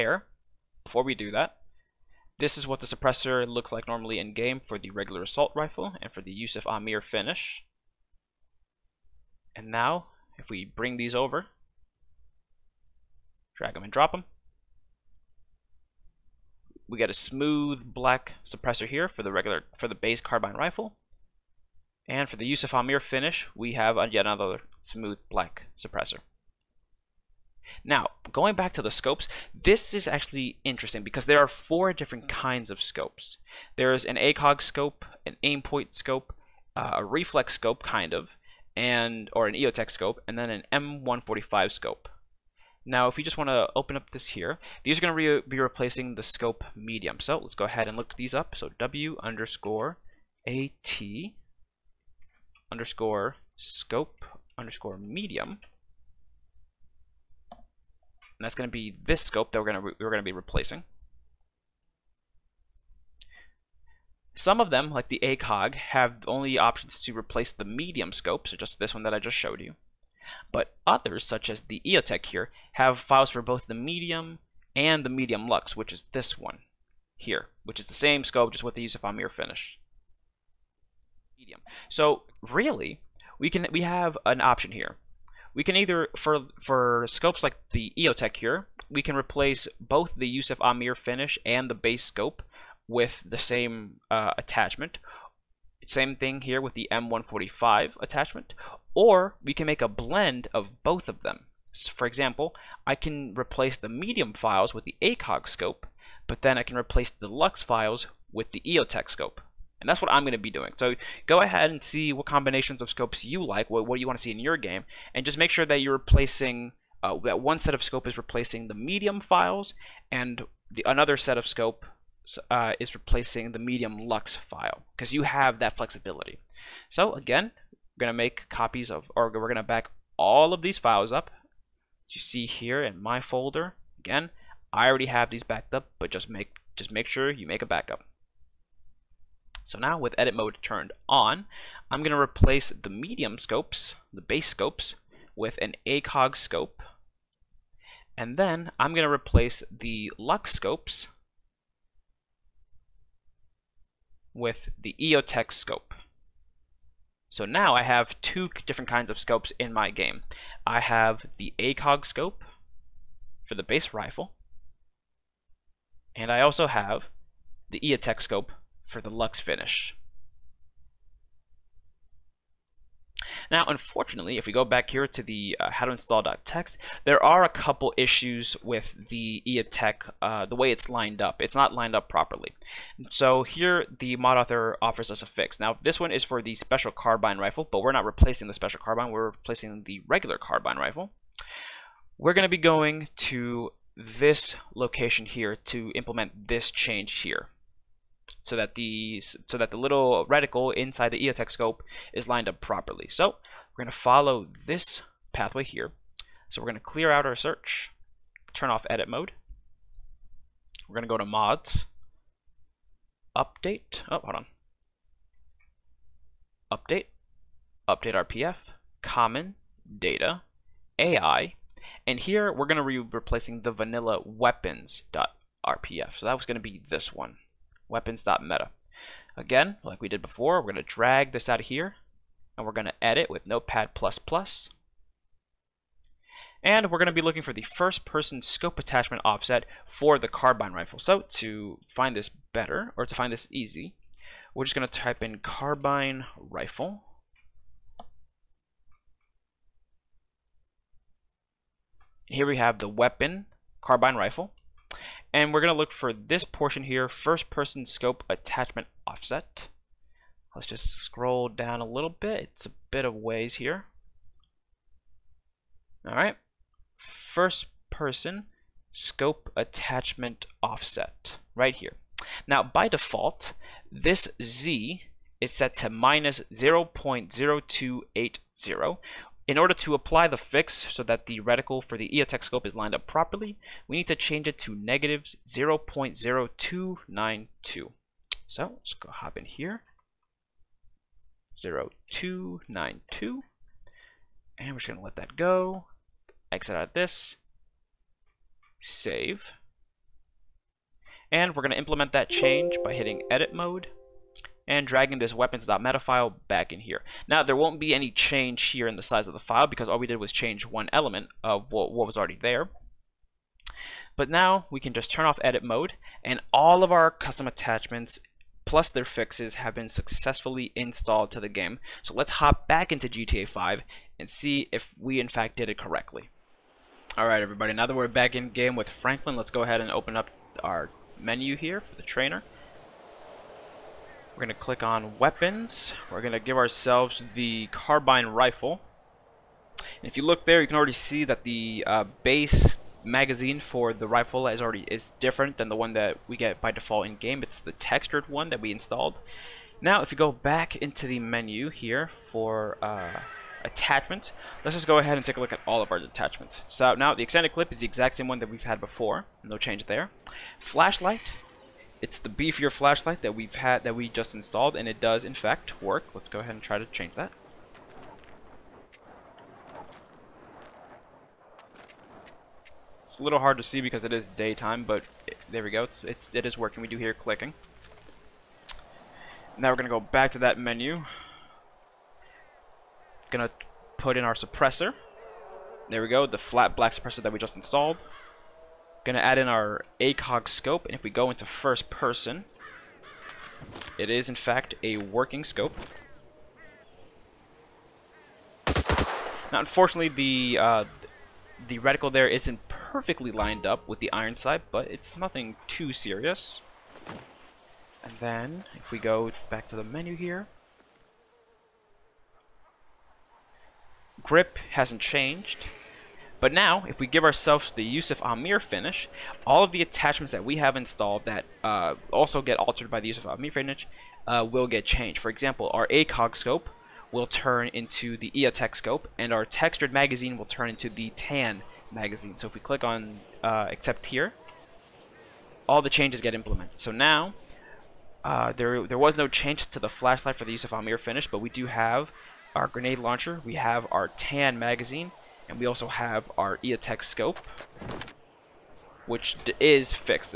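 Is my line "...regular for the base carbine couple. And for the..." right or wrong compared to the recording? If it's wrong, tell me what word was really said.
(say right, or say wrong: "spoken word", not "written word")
wrong: "rifle", not "couple".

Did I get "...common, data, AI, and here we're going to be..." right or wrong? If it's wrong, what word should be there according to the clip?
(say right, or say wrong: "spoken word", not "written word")
right.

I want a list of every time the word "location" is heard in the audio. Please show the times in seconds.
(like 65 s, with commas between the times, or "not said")
194 s.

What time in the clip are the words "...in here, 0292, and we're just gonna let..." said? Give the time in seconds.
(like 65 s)
289 s.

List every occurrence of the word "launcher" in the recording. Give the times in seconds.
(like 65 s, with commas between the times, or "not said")
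442 s.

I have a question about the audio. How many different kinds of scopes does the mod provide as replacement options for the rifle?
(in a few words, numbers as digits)
4.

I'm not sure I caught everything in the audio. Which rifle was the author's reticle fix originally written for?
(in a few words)
special carbine rifle.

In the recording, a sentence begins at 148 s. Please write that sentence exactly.
And then I'm going to replace the lux scopes with the EOTech scope.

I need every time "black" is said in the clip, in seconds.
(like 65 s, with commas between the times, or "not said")
17 s, 25 s, 386 s.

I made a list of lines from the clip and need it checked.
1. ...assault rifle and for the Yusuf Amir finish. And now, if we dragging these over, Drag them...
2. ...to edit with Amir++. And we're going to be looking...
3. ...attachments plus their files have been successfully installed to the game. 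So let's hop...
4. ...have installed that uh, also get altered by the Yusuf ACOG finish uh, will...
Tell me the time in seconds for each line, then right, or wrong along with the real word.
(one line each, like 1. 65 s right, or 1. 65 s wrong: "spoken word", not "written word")
1. 5 s wrong: "bring", not "dragging"
2. 232 s wrong: "Notepad", not "Amir"
3. 317 s wrong: "fixes", not "files"
4. 420 s wrong: "Amir", not "ACOG".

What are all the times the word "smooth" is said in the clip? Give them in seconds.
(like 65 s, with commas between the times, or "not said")
17 s, 24 s.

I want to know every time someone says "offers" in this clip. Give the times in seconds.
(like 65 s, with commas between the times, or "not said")
184 s.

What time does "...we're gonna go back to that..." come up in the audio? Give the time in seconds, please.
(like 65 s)
379 s.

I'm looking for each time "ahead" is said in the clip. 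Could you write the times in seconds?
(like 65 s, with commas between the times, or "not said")
47 s, 111 s, 329 s, 354 s, 366 s.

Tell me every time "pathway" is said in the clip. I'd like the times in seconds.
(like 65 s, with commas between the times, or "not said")
205 s.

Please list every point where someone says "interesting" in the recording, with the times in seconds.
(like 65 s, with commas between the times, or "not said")
30 s.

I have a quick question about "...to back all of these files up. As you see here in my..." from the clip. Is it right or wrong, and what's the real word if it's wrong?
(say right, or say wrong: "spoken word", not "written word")
right.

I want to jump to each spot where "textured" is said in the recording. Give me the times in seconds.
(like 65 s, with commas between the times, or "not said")
347 s, 429 s.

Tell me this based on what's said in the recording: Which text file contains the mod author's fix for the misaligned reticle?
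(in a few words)
how to install.txt.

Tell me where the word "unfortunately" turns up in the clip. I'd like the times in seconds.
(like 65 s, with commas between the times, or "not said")
173 s, 399 s.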